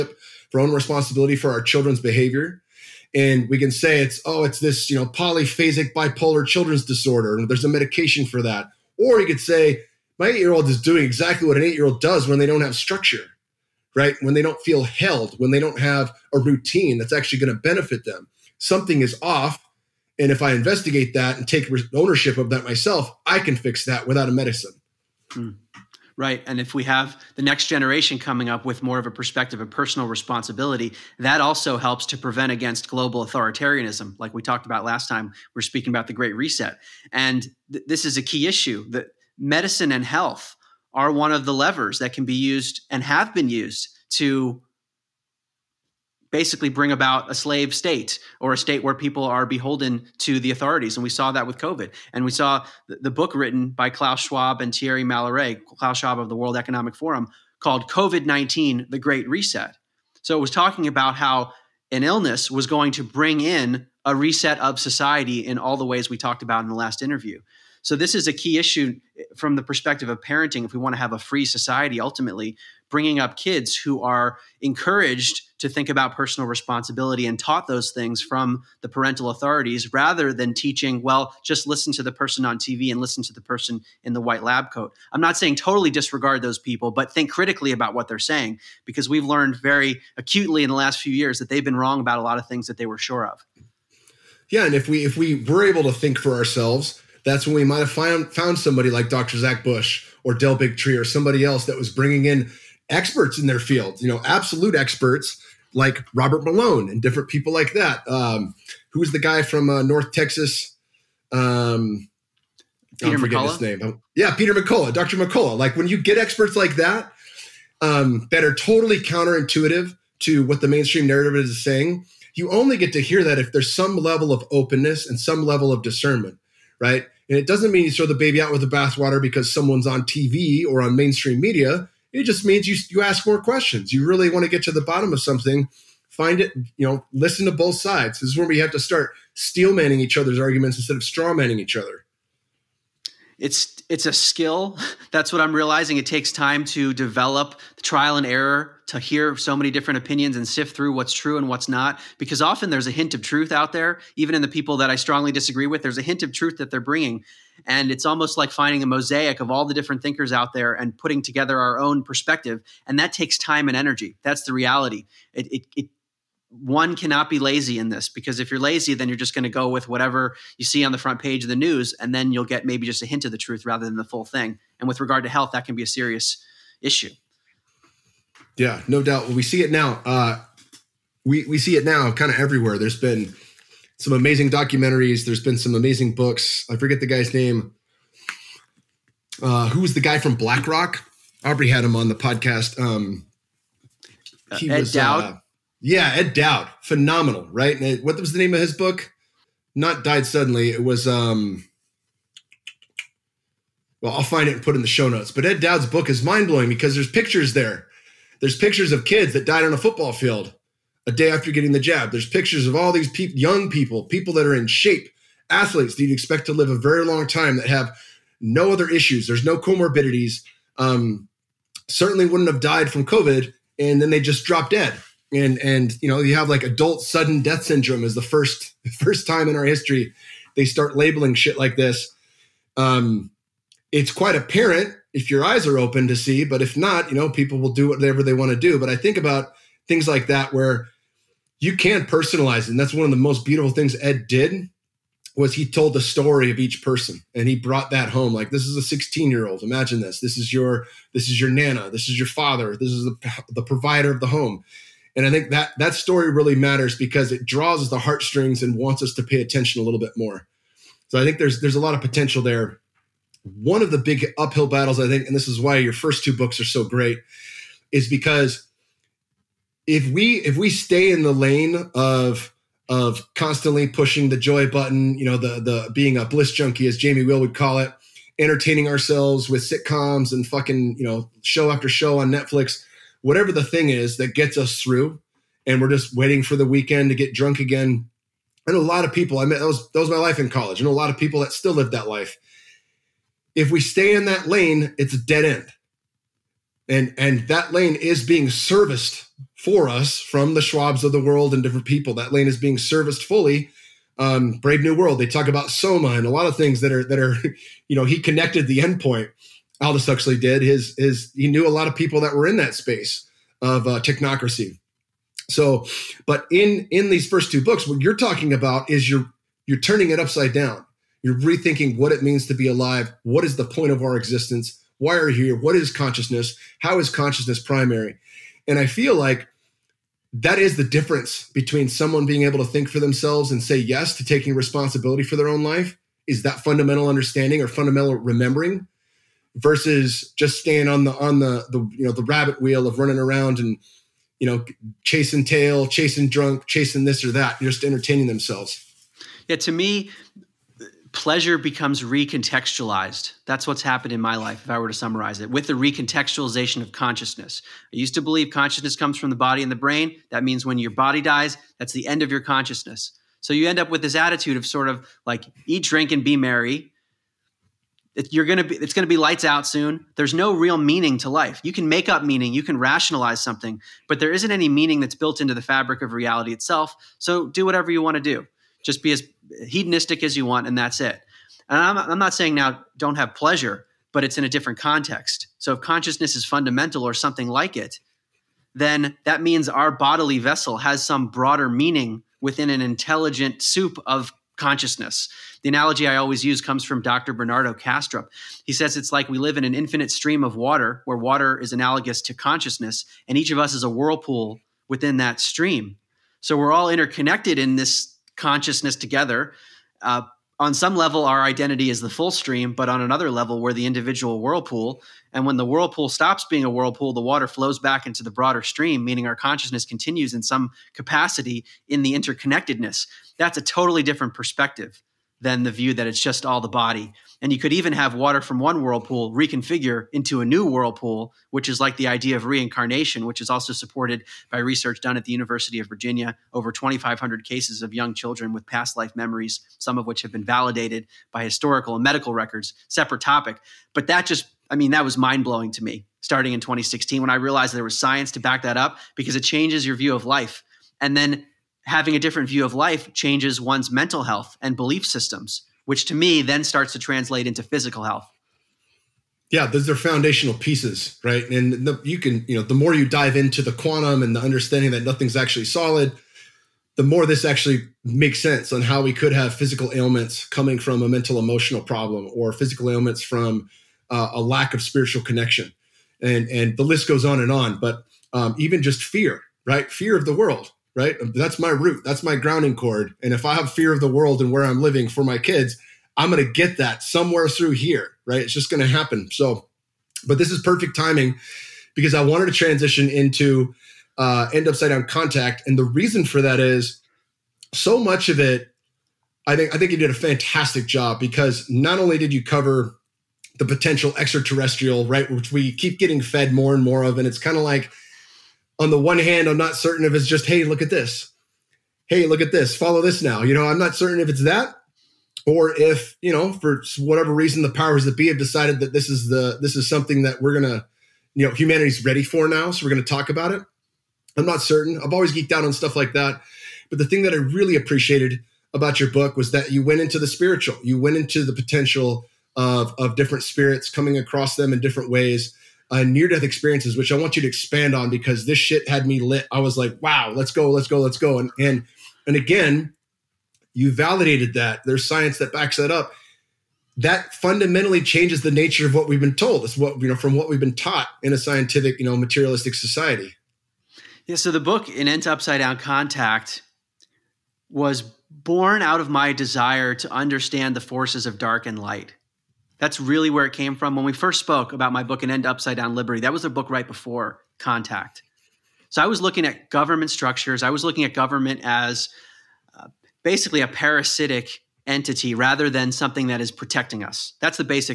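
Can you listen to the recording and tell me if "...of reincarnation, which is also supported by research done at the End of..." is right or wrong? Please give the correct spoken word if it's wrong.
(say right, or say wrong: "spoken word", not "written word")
wrong: "University", not "End".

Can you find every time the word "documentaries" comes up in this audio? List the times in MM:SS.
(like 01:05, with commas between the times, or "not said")
03:04.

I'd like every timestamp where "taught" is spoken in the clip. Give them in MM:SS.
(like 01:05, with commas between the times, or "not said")
01:17, 09:10.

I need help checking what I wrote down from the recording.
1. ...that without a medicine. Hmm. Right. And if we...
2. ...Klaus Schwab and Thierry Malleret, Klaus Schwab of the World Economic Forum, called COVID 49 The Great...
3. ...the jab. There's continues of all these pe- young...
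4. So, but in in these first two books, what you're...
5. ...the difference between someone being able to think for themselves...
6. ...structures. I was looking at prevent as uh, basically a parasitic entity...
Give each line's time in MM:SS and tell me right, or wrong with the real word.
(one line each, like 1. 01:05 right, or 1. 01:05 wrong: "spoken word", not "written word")
1. 00:23 right
2. 00:53 wrong: "19", not "49"
3. 03:31 wrong: "pictures", not "continues"
4. 05:15 right
5. 05:30 right
6. 09:30 wrong: "government", not "prevent".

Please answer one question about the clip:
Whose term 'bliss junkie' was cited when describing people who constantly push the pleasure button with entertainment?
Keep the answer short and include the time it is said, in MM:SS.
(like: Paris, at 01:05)
Jamie Wheal, at 04:36.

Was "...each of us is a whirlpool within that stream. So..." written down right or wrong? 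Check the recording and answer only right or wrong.
right.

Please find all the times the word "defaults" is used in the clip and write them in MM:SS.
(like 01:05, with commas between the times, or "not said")
not said.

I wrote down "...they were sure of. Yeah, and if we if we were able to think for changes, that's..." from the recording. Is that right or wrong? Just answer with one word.
wrong.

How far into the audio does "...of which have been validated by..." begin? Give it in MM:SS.
07:19.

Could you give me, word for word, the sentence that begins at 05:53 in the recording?
That's what's happened in my life, if I were to summarize it, with the recontextualization of consciousness.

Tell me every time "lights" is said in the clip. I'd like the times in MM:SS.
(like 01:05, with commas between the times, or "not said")
06:09, 09:21.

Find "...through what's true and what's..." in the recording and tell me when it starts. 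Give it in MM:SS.
02:30.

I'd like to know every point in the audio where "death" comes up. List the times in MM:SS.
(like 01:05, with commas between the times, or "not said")
03:47, 08:56.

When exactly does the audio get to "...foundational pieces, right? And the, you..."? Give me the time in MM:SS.
07:39.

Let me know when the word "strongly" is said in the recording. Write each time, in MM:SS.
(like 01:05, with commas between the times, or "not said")
02:34.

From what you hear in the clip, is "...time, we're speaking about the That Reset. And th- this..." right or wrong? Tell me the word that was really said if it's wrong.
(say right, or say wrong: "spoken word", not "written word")
wrong: "Great", not "That".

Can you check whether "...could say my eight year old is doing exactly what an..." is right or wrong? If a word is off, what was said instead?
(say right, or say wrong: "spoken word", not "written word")
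right.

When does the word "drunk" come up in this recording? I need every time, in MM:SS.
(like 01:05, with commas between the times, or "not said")
04:47, 05:46.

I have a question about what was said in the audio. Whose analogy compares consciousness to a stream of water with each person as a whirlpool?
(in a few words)
Bernardo Kastrup.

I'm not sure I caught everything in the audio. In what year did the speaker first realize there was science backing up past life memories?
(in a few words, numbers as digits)
2016.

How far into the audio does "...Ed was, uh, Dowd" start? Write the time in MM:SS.
03:14.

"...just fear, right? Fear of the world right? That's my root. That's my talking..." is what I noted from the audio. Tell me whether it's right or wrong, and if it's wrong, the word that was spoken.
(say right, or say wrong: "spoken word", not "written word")
wrong: "grounding", not "talking".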